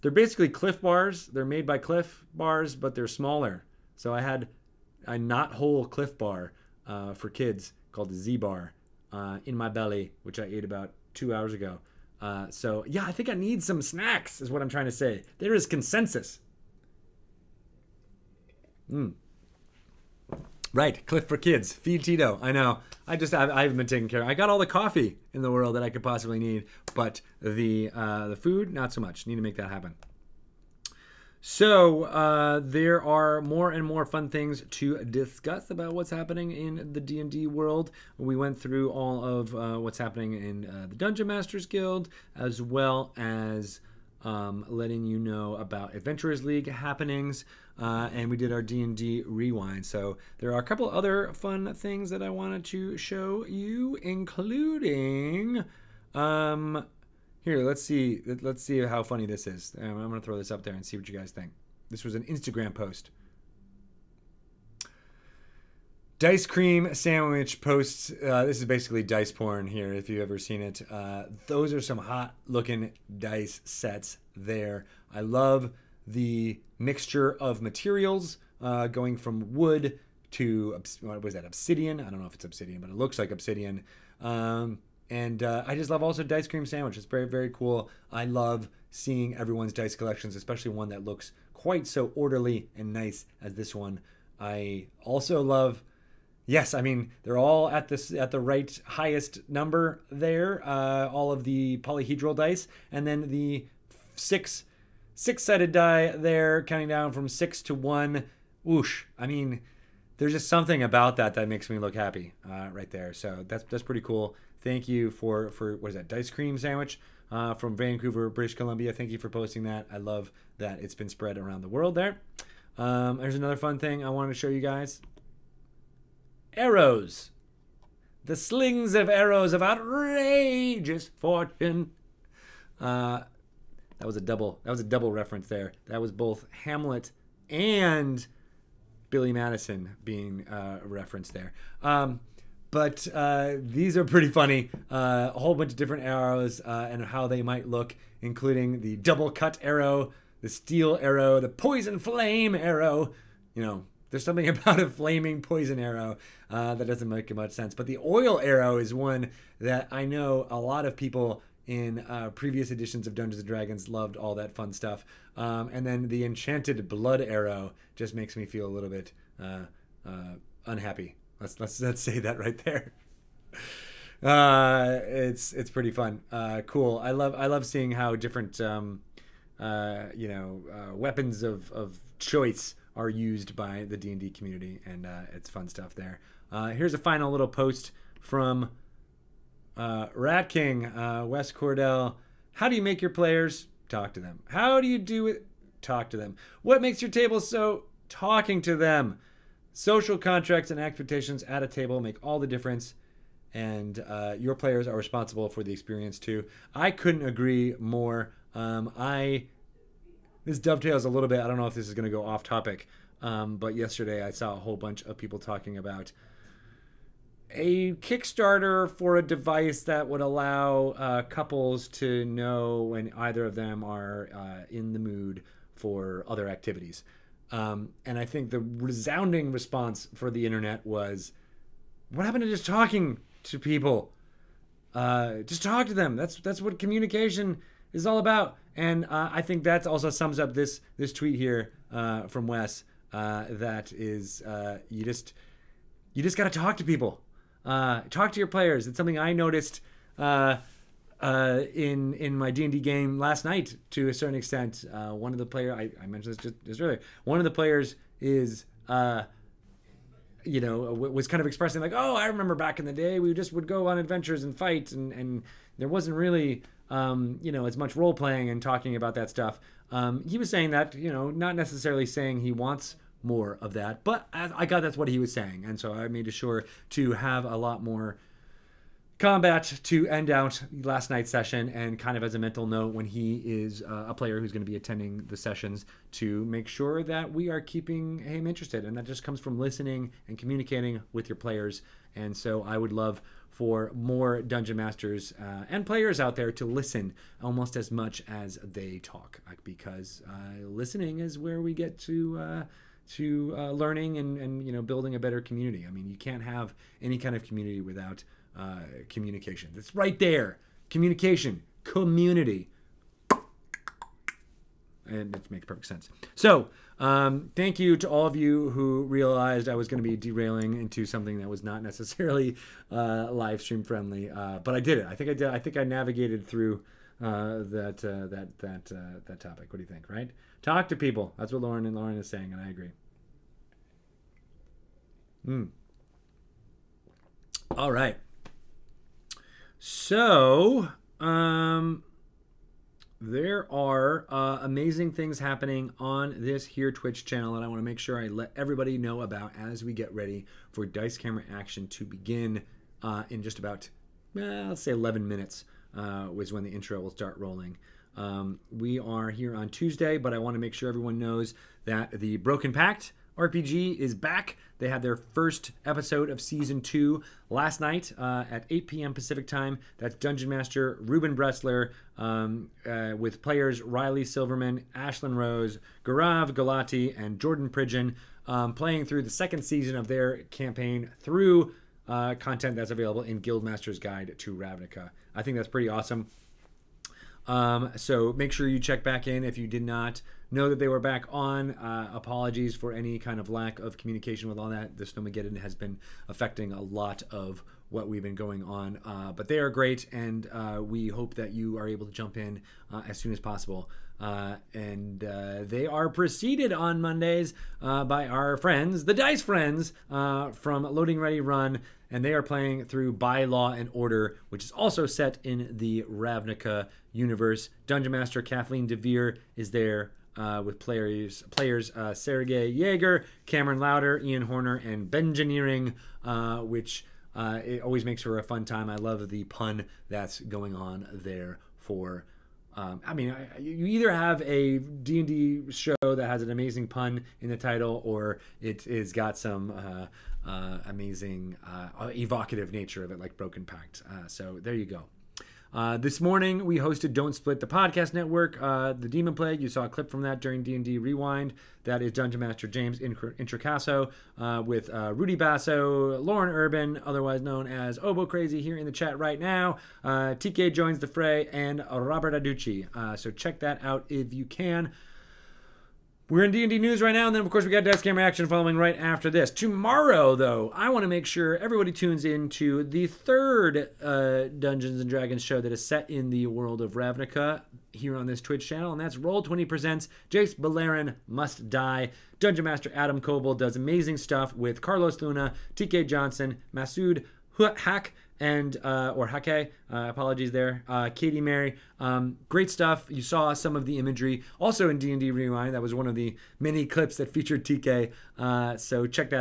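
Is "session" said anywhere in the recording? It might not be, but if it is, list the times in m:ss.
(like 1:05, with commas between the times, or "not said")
4:41, 4:45.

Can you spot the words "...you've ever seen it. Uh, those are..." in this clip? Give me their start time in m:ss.
1:10.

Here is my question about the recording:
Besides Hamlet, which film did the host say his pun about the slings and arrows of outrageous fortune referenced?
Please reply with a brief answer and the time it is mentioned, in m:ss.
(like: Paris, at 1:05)
Billy Madison, at 2:19.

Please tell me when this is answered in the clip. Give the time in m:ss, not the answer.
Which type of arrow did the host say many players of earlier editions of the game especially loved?
2:37.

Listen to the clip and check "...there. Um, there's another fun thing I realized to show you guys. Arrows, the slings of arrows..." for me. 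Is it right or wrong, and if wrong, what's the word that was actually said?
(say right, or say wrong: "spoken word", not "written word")
wrong: "wanted", not "realized".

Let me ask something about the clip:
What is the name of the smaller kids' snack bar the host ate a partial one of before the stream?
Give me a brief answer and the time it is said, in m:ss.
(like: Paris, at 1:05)
Z bar, at 0:08.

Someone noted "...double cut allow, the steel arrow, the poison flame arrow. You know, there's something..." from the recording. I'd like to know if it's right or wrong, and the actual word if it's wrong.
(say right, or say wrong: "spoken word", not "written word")
wrong: "arrow", not "allow".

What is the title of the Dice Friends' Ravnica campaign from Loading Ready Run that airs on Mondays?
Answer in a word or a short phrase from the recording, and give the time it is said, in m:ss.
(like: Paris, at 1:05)
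By Law and Order, at 6:53.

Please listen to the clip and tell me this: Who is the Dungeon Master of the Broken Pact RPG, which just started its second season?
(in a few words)
Ruben Bressler.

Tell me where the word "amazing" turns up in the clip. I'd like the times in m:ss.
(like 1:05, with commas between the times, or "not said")
5:44, 7:16, 7:20, 8:03.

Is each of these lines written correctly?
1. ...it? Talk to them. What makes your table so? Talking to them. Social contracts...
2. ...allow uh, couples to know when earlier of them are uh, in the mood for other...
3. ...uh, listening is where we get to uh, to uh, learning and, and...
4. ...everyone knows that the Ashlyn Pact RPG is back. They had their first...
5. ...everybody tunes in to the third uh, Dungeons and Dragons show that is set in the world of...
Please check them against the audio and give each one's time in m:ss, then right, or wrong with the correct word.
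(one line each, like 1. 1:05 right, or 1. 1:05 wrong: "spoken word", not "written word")
1. 3:15 right
2. 3:40 wrong: "either", not "earlier"
3. 5:00 right
4. 6:00 wrong: "Broken", not "Ashlyn"
5. 7:51 right.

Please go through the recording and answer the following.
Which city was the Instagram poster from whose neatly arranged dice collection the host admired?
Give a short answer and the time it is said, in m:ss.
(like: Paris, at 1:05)
Vancouver, at 1:57.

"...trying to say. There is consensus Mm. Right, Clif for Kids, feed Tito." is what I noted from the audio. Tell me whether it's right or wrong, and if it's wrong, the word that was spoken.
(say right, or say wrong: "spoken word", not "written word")
right.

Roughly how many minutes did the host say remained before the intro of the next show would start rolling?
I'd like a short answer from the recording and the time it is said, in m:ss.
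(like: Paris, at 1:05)
11, at 5:54.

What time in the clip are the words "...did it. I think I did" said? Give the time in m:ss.
5:24.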